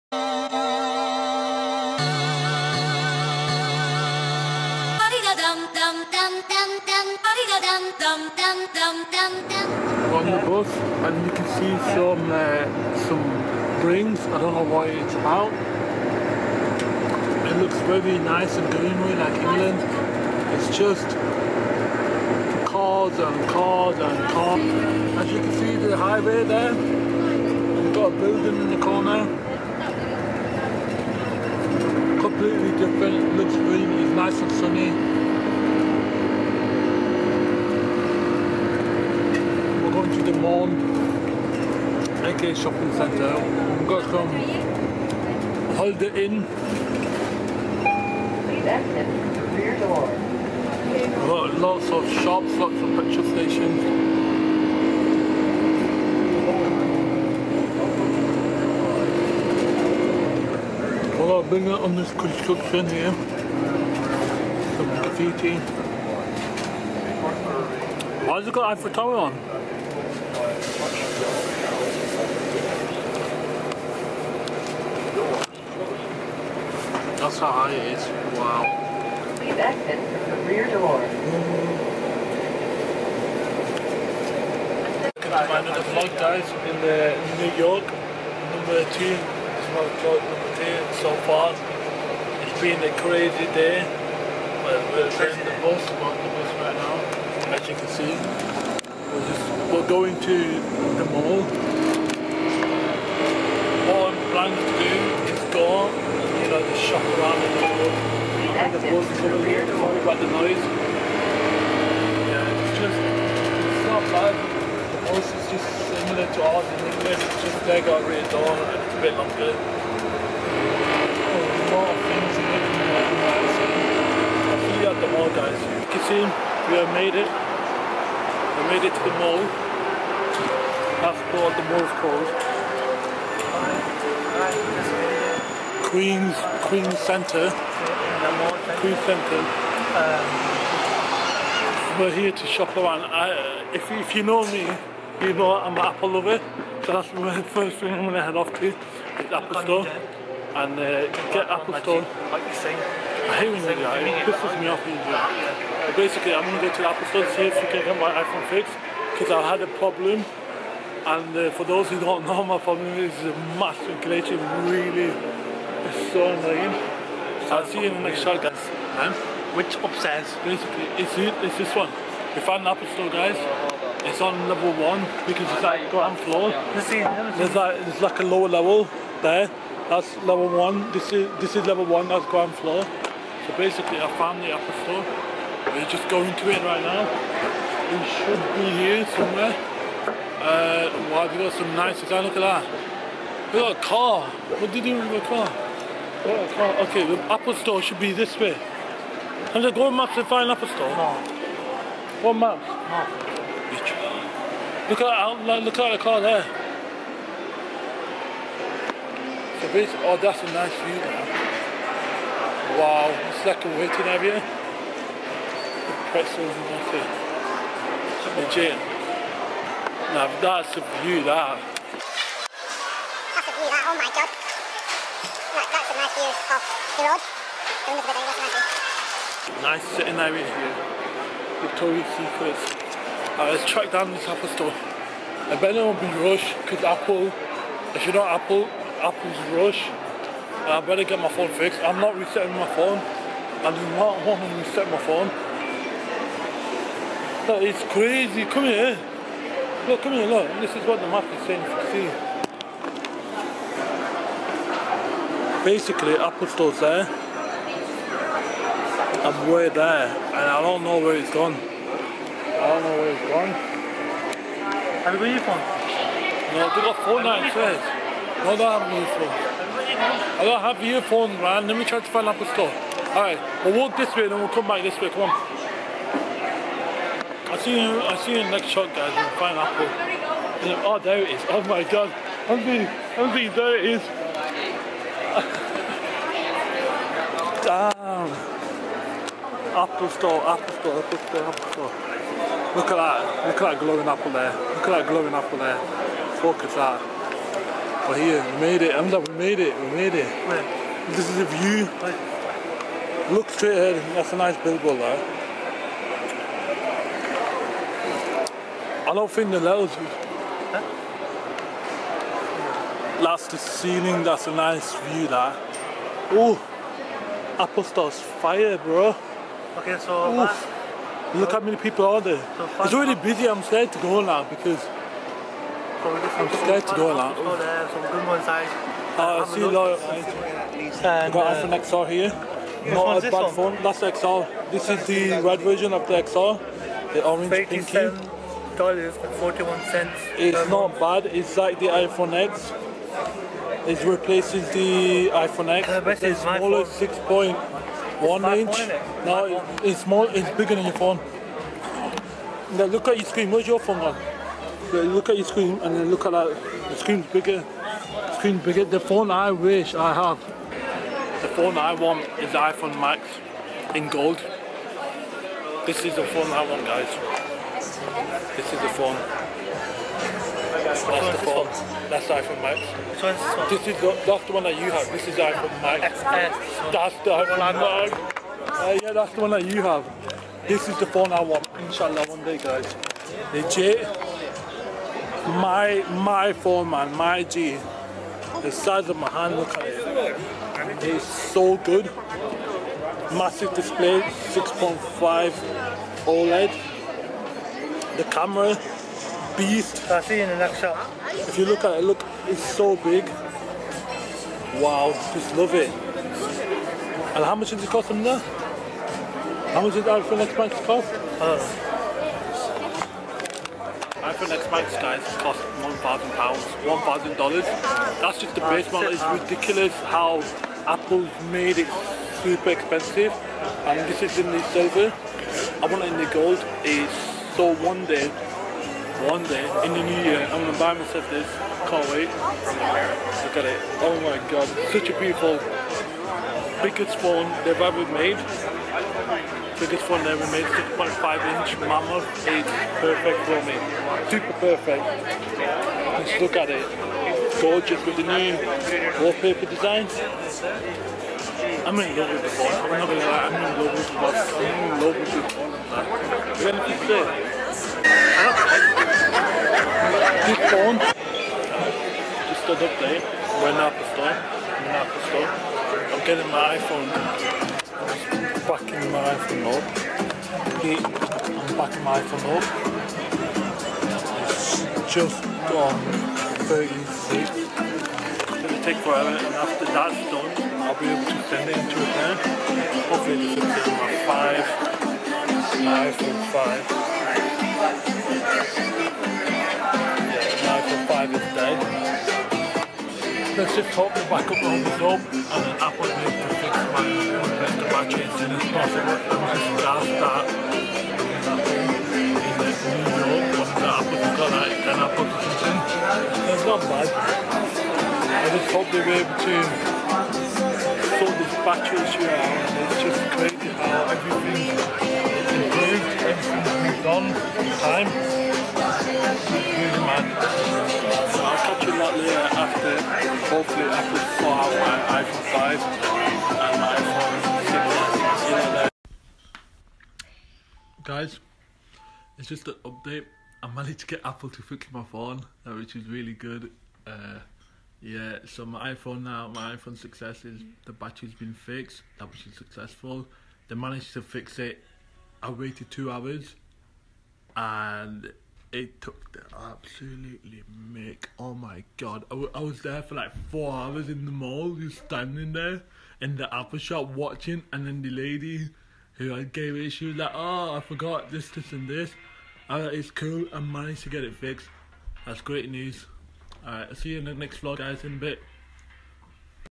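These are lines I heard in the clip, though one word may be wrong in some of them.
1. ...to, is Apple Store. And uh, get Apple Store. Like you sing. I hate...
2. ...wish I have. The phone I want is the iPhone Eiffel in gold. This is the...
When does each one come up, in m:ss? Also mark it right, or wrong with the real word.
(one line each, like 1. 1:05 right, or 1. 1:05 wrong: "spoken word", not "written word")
1. 2:28 right
2. 5:59 wrong: "Max", not "Eiffel".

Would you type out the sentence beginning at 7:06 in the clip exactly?
It's so one day one day in the new year, I'm gonna buy myself this.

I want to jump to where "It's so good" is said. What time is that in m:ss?
6:31.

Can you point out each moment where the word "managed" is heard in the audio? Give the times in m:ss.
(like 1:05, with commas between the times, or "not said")
8:53, 9:03, 9:23.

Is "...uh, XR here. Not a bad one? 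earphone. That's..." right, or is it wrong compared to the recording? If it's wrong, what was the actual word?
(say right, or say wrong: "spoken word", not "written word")
wrong: "phone", not "earphone".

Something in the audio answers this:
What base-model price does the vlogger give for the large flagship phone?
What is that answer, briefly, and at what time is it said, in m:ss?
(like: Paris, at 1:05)
$1,000, at 6:55.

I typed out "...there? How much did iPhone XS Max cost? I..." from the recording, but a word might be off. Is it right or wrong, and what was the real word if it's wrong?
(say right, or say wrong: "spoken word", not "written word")
right.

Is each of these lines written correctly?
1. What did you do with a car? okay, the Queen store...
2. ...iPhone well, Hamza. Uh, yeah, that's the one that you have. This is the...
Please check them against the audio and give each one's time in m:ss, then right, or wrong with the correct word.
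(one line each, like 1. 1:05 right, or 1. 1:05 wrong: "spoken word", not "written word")
1. 3:14 wrong: "Apple", not "Queen"
2. 6:17 wrong: "Max", not "Hamza".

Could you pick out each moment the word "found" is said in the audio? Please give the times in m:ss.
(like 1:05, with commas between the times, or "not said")
2:52, 3:04.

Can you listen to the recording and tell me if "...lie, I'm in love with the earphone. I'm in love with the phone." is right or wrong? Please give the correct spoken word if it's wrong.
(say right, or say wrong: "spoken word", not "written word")
wrong: "phone", not "earphone".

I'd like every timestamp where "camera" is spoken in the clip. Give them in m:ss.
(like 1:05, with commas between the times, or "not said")
6:38.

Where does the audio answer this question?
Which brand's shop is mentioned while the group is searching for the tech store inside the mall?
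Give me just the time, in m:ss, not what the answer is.
3:51.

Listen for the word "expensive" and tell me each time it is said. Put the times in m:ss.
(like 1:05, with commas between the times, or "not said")
7:02.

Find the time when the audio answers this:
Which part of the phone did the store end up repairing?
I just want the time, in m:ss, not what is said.
9:00.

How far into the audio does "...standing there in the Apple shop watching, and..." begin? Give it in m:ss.
9:14.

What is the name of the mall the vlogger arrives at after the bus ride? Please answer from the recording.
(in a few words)
Queen Centre.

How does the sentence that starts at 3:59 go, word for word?
And I better get my phone fixed.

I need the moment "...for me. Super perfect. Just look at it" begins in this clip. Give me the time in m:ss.
7:23.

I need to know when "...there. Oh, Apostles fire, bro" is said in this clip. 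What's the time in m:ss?
5:15.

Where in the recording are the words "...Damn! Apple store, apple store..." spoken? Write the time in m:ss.
4:47.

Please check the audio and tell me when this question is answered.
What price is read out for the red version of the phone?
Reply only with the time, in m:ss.
5:38.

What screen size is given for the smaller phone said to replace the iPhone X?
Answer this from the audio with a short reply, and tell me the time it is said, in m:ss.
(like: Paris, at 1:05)
6.1 inch, at 5:46.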